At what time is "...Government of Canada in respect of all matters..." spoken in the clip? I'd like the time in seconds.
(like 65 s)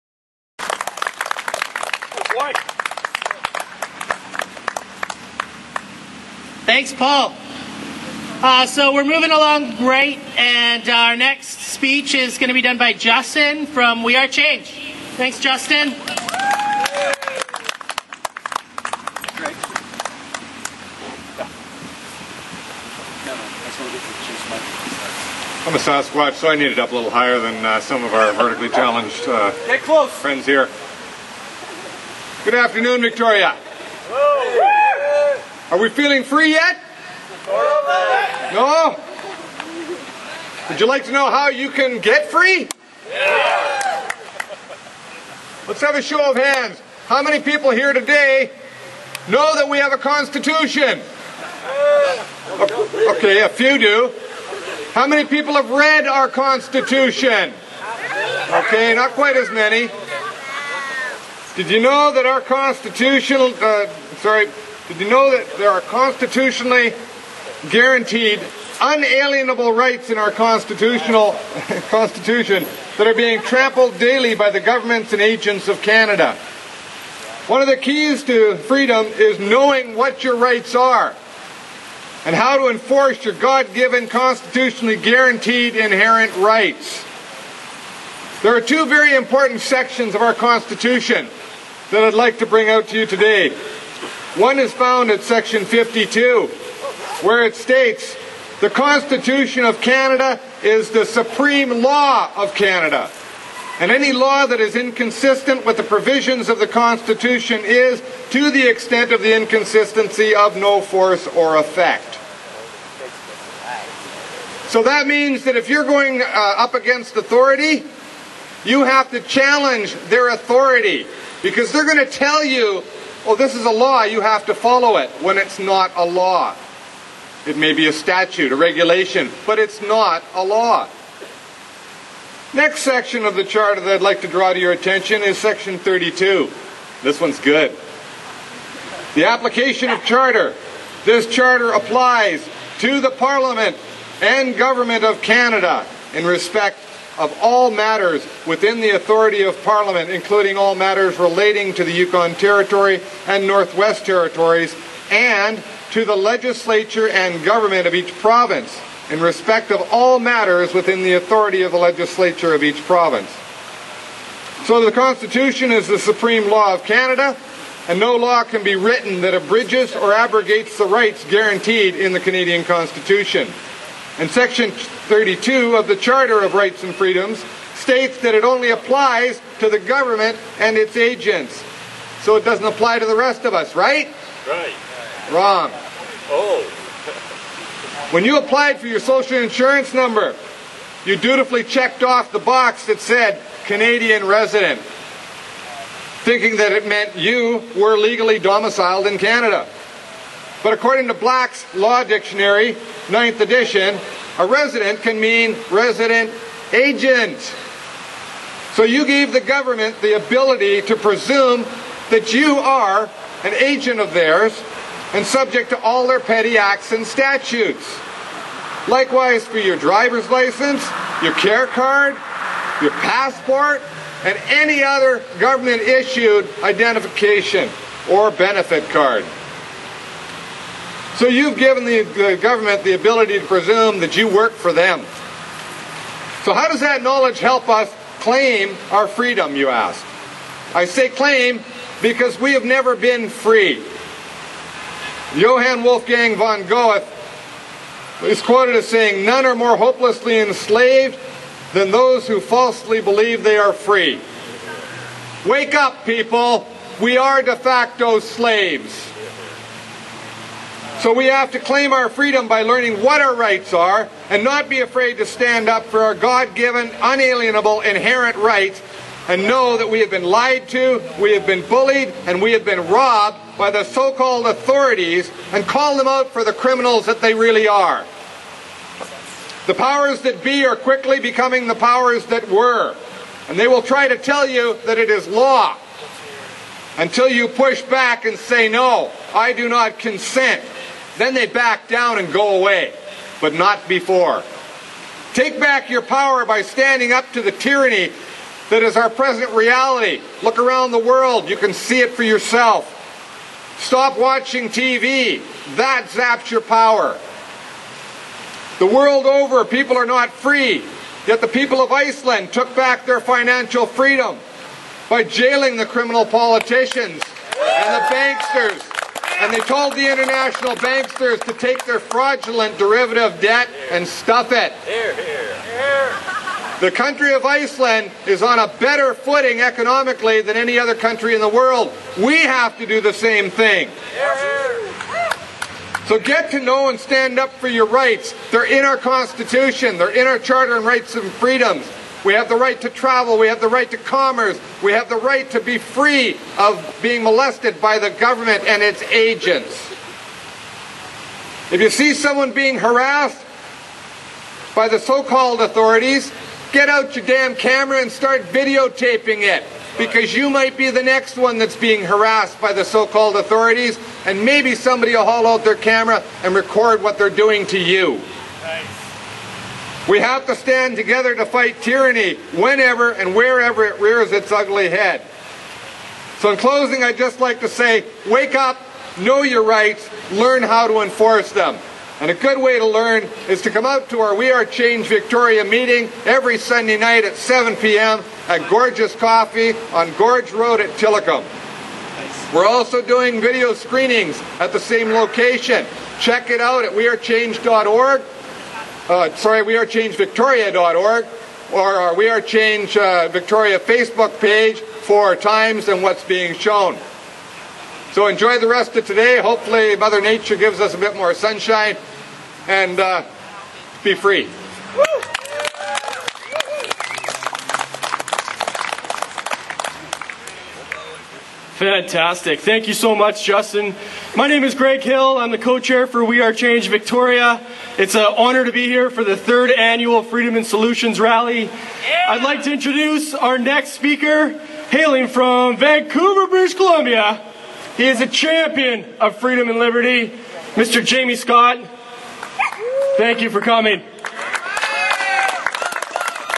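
144 s.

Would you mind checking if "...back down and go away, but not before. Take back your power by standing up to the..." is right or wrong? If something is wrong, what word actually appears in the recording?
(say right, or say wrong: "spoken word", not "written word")
right.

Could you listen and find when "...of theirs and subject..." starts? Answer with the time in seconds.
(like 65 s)
213 s.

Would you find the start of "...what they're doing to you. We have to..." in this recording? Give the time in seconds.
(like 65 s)
367 s.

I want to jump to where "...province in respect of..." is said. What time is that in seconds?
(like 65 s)
158 s.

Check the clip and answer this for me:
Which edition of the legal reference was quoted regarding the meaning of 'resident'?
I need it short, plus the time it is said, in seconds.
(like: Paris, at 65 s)
Ninth edition, at 203 s.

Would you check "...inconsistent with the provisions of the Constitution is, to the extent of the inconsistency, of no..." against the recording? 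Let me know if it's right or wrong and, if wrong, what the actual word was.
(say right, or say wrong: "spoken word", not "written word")
right.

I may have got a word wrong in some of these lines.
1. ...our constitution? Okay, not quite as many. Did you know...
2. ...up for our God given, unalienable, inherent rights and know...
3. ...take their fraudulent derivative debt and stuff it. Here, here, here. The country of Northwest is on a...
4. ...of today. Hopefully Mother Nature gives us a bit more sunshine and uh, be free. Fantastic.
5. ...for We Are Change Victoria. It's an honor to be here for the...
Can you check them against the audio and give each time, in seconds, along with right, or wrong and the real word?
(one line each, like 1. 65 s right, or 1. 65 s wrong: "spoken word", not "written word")
1. 56 s right
2. 265 s right
3. 321 s wrong: "Iceland", not "Northwest"
4. 408 s right
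5. 426 s right.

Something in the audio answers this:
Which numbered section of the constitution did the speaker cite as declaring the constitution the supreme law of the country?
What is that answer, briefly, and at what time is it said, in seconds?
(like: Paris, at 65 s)
52, at 95 s.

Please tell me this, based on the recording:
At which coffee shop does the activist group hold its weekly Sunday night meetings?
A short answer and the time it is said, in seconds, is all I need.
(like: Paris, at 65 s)
Gorgeous Coffee, at 388 s.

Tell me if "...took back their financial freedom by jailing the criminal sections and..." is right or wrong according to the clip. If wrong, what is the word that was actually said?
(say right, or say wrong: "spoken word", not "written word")
wrong: "politicians", not "sections".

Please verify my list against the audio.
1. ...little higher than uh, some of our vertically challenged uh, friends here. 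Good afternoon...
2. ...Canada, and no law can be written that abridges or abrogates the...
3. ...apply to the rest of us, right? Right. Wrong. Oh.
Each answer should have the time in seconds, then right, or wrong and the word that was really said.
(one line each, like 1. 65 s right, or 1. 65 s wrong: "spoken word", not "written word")
1. 26 s right
2. 166 s right
3. 182 s right.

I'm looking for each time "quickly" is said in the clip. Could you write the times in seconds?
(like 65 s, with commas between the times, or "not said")
280 s.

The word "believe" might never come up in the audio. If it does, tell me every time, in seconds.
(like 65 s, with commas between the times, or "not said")
253 s.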